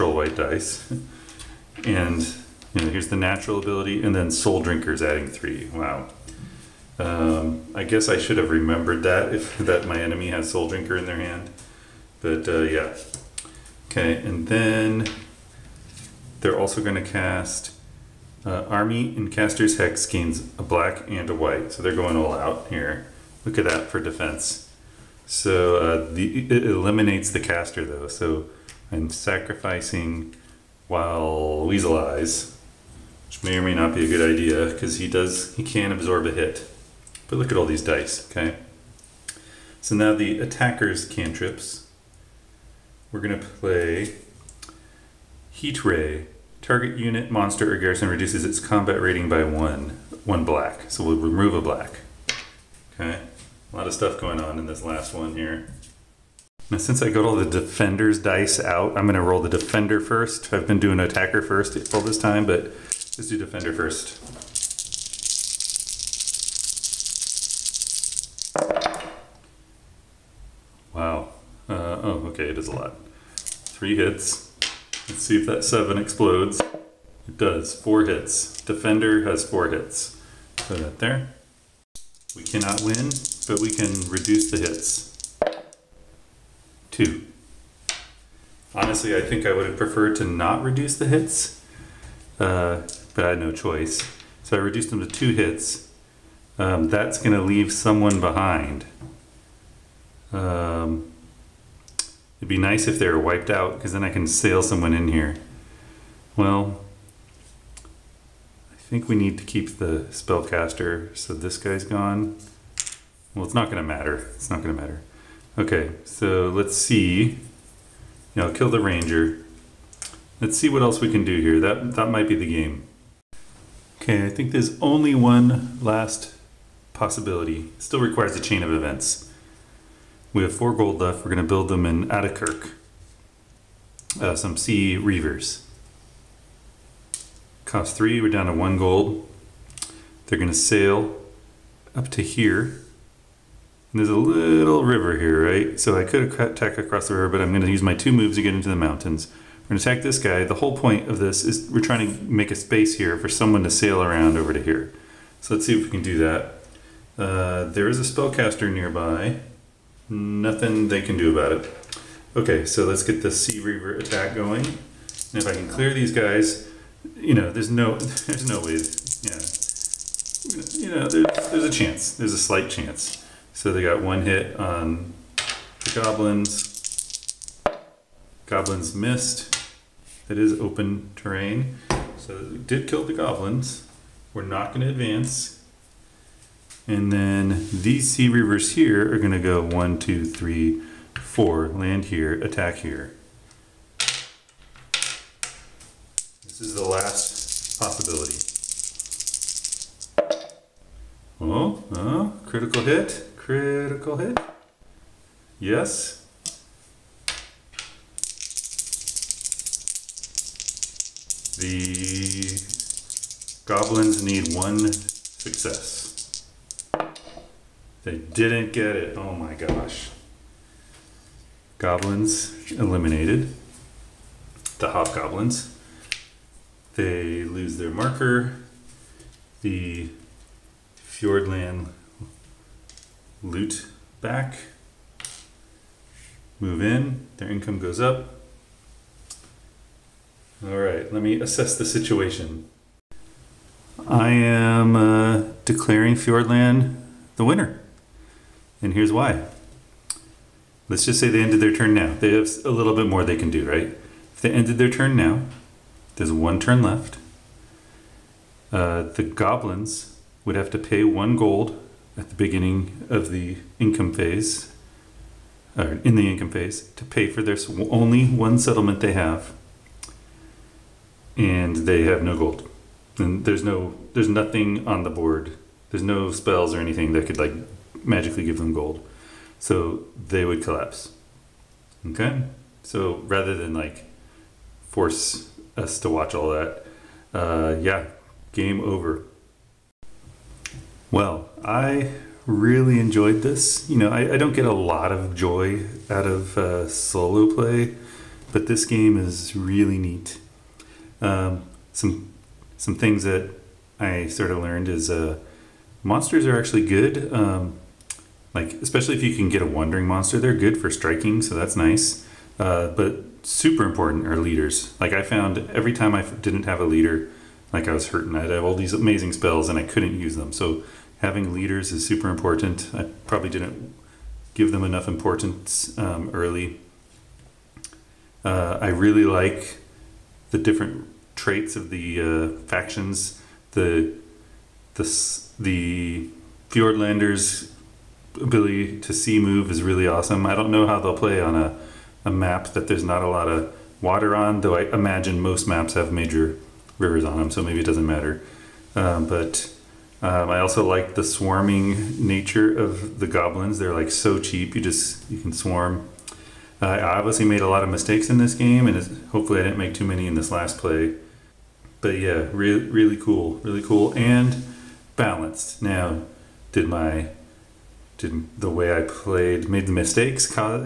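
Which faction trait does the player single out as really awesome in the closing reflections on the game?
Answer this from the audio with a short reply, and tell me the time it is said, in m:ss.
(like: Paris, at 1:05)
Sea move, at 5:39.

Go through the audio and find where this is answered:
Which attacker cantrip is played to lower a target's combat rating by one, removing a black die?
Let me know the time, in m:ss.
0:45.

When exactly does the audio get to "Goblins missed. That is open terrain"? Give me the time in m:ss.
2:58.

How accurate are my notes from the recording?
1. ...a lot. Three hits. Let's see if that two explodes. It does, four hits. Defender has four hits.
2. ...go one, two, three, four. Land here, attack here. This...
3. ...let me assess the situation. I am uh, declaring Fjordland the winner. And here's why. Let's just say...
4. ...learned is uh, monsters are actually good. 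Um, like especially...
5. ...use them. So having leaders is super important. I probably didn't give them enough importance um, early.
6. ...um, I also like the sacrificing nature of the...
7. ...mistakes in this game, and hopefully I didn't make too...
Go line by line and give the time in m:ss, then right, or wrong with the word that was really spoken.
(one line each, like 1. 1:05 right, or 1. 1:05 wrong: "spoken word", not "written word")
1. 1:12 wrong: "seven", not "two"
2. 3:09 right
3. 4:01 right
4. 5:04 right
5. 5:20 right
6. 5:50 wrong: "swarming", not "sacrificing"
7. 5:57 right.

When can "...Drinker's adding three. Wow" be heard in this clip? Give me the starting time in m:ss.
0:04.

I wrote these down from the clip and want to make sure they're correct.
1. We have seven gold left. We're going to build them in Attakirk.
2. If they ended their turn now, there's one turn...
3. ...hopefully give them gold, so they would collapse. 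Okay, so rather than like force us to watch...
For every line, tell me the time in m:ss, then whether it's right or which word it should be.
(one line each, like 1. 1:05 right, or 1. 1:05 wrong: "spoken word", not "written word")
1. 2:10 wrong: "four", not "seven"
2. 4:14 right
3. 4:38 wrong: "magically", not "hopefully".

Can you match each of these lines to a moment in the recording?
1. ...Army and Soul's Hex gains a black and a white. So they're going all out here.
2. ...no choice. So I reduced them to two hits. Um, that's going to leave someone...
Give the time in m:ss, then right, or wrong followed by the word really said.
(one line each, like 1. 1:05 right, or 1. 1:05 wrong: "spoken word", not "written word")
1. 0:18 wrong: "Caster", not "Soul"
2. 1:33 right.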